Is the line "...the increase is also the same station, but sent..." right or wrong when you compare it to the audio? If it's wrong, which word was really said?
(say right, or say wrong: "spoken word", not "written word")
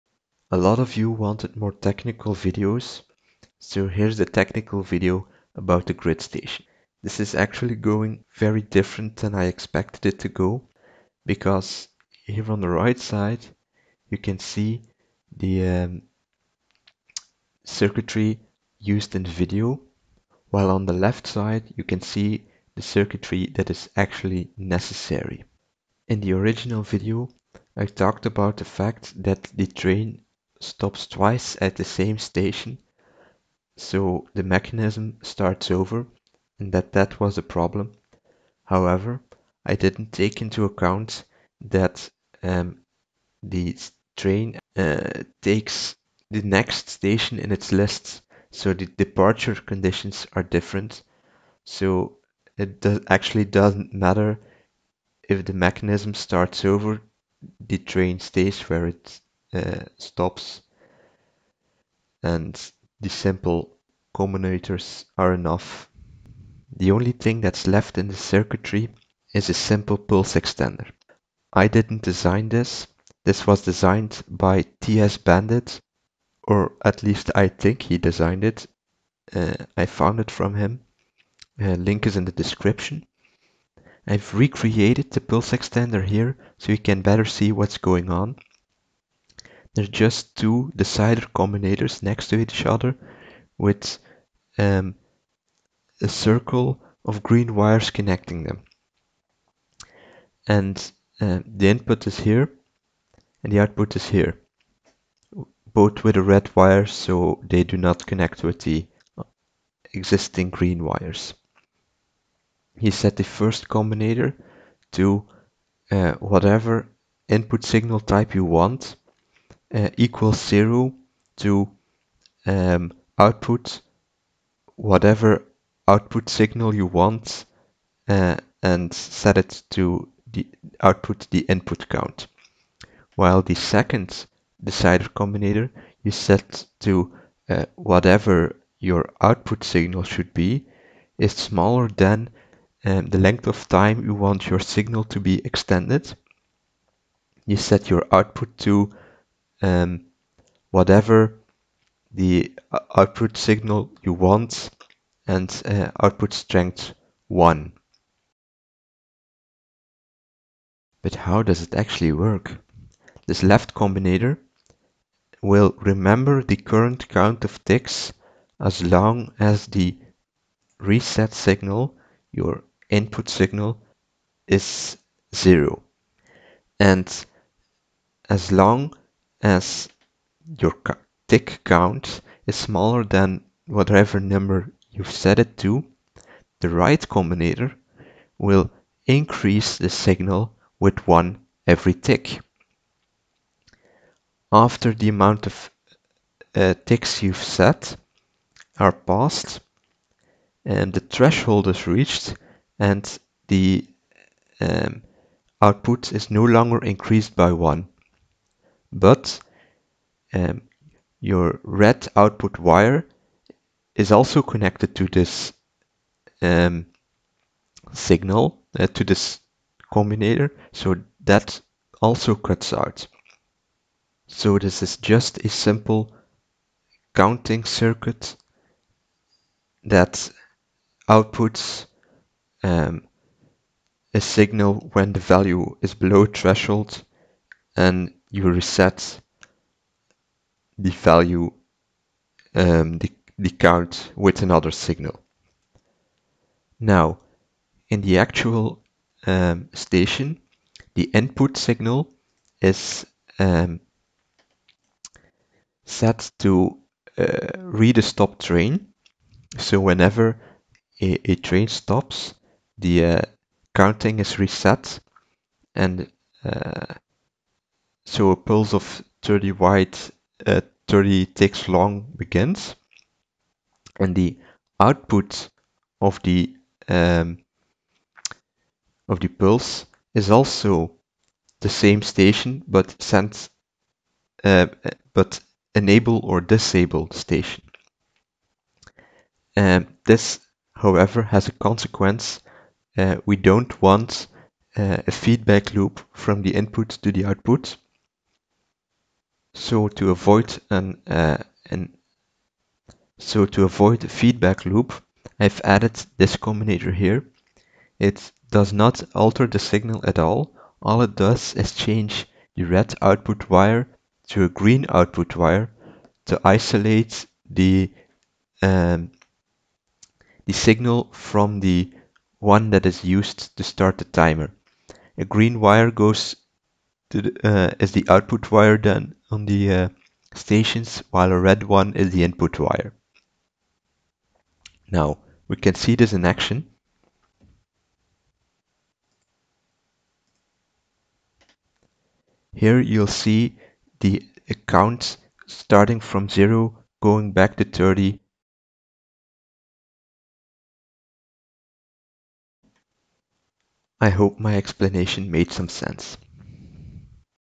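wrong: "pulse", not "increase".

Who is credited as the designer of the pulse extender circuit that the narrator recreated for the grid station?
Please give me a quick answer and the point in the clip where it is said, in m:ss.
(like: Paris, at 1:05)
TS Bandit, at 1:14.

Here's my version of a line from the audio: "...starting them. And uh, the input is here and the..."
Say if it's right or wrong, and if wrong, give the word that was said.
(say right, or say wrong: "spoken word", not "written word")
wrong: "connecting", not "starting".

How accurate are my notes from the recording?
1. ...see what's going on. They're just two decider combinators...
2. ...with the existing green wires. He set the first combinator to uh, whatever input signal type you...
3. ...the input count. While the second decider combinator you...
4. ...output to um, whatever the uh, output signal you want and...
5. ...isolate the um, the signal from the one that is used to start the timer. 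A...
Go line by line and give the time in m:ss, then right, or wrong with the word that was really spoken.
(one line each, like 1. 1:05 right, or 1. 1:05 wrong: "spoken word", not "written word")
1. 1:27 right
2. 1:48 right
3. 2:11 right
4. 2:28 right
5. 5:16 right.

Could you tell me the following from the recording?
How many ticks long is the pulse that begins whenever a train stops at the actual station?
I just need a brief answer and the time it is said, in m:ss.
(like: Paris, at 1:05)
30, at 4:30.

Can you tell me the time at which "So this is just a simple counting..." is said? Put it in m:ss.
3:44.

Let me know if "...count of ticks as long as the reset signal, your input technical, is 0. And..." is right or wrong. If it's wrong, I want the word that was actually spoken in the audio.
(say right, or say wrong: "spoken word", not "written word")
wrong: "signal", not "technical".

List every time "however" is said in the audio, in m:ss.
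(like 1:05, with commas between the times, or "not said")
0:38, 4:50.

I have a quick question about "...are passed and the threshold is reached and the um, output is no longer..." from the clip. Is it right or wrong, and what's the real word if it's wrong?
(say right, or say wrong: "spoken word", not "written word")
right.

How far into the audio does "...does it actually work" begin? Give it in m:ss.
2:41.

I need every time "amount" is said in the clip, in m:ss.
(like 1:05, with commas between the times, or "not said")
3:15.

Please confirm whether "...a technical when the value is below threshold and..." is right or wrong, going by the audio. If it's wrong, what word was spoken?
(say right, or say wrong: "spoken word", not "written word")
wrong: "signal", not "technical".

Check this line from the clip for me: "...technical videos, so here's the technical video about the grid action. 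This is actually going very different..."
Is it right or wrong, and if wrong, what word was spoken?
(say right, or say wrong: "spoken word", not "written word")
wrong: "station", not "action".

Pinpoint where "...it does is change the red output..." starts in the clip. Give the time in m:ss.
5:11.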